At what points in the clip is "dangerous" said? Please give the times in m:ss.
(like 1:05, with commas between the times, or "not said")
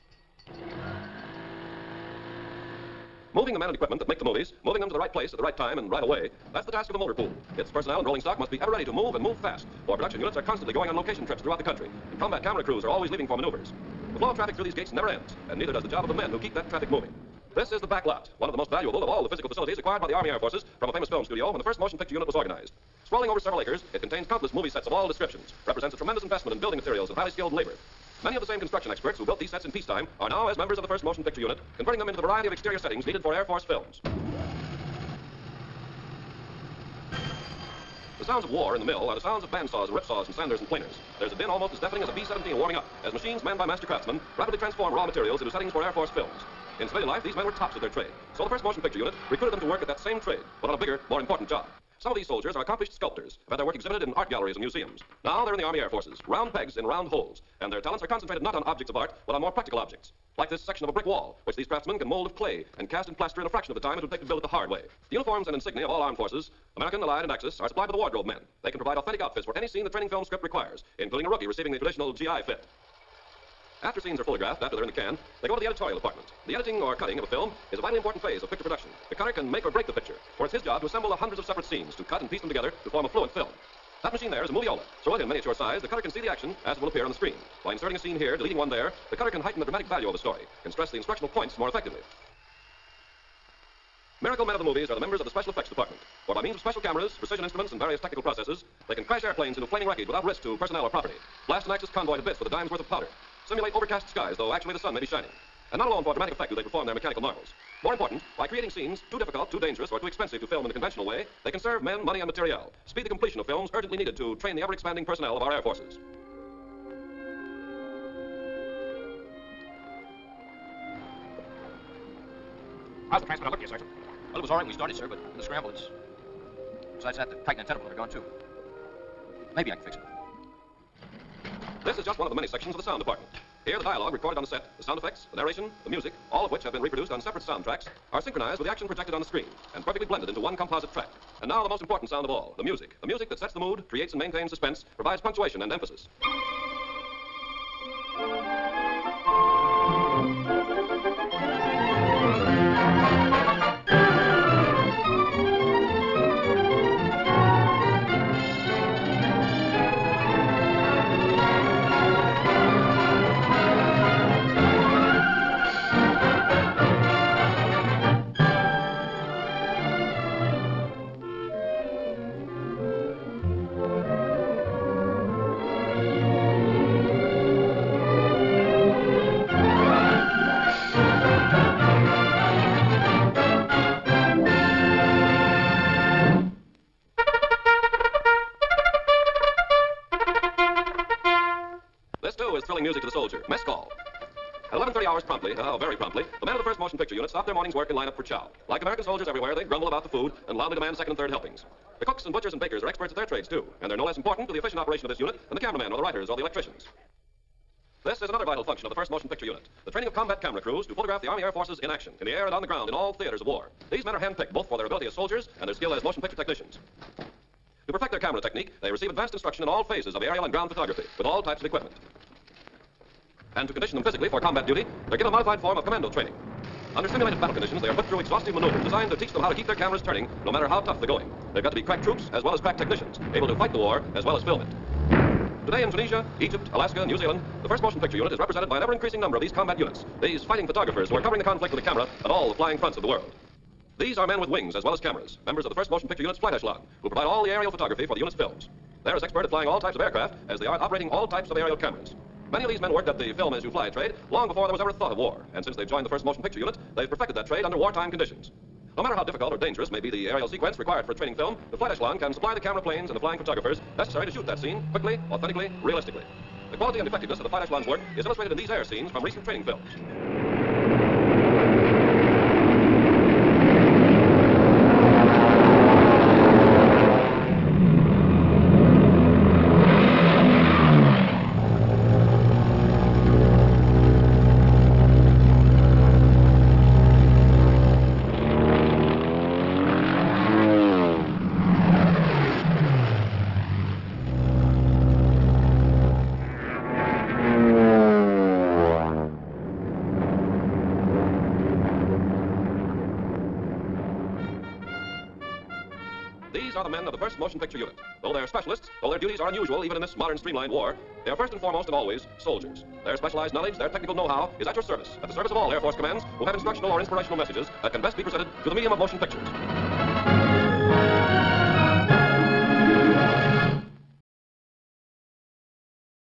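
1:49, 4:19.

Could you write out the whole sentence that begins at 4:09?
They're as expert at flying all types of aircraft as they are at operating all types of aerial cameras.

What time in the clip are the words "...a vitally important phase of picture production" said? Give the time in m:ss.
1:17.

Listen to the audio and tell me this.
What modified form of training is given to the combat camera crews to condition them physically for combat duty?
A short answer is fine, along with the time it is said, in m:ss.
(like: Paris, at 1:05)
commando training, at 3:45.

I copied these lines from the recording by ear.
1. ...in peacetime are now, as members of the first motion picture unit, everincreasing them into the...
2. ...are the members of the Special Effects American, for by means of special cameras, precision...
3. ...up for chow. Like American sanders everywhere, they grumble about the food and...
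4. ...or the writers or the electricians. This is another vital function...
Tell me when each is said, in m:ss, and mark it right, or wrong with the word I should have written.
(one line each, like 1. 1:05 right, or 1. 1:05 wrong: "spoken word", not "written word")
1. 0:29 wrong: "converting", not "everincreasing"
2. 1:34 wrong: "Department", not "American"
3. 3:18 wrong: "soldiers", not "sanders"
4. 3:25 right.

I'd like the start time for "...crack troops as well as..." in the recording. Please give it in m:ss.
3:51.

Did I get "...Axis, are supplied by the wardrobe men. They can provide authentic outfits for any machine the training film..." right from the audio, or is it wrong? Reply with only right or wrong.
wrong.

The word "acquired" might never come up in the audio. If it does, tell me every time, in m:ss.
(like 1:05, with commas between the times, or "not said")
0:19.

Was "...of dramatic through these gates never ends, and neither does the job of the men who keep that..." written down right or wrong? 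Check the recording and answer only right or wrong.
wrong.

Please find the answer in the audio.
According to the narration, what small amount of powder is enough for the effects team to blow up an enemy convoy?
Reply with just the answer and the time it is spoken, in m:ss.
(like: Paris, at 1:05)
a dime's worth, at 1:42.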